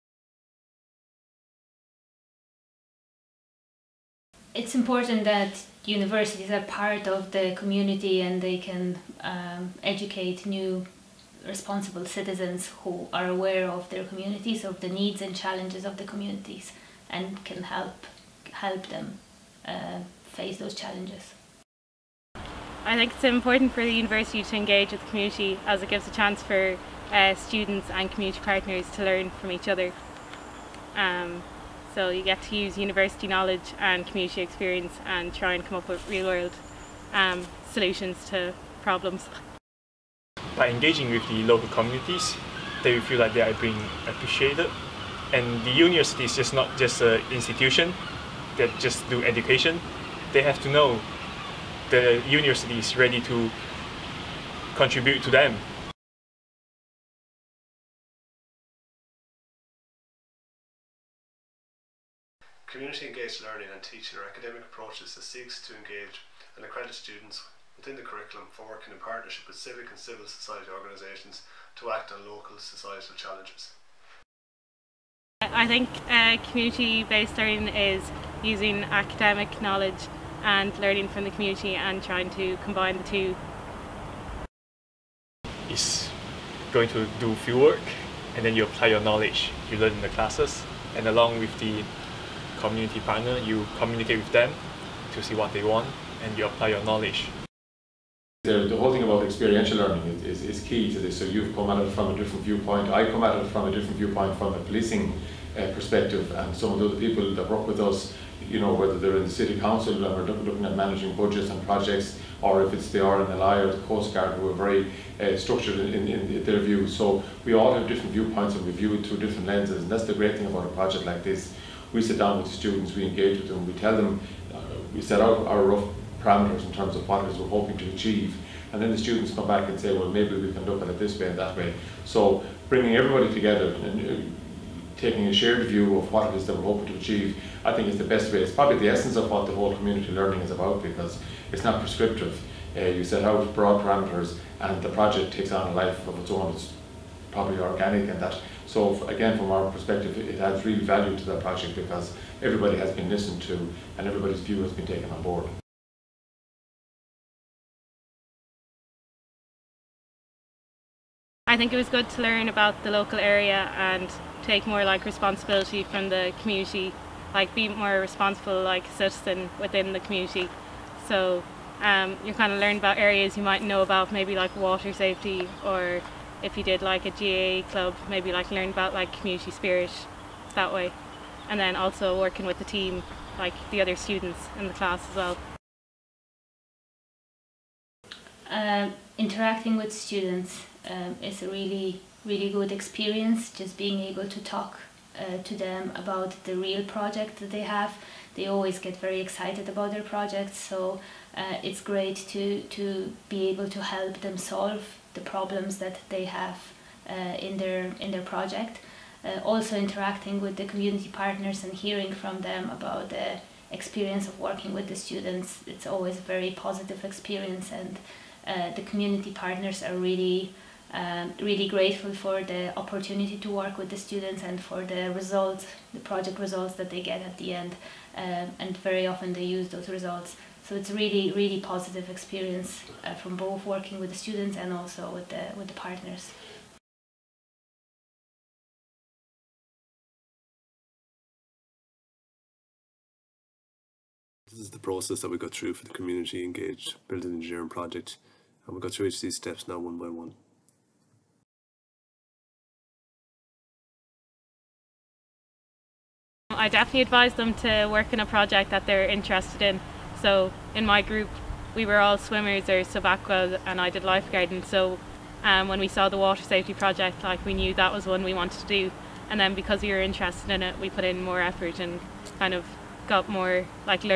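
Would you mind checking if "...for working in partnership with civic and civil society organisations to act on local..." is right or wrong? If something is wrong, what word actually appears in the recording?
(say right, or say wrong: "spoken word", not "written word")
right.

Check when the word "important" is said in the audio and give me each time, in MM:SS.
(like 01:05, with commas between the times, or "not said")
00:04, 00:23.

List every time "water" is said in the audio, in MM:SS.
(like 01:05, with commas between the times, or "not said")
02:54, 04:26.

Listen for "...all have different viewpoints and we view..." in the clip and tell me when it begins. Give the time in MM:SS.
01:57.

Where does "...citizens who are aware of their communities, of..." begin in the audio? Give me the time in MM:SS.
00:12.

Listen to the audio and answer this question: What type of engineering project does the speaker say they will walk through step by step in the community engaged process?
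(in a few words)
Building engineering.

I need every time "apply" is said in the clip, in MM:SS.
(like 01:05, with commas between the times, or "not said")
01:28, 01:36.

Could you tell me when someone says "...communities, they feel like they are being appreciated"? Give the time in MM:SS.
00:41.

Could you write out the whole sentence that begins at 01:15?
I think uh, community-based learning is using academic knowledge and learning from the community and trying to combine the two.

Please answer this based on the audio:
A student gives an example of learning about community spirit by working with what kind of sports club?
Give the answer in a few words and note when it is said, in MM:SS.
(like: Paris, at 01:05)
GAA club, at 02:57.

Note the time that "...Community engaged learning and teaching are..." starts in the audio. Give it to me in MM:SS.
01:02.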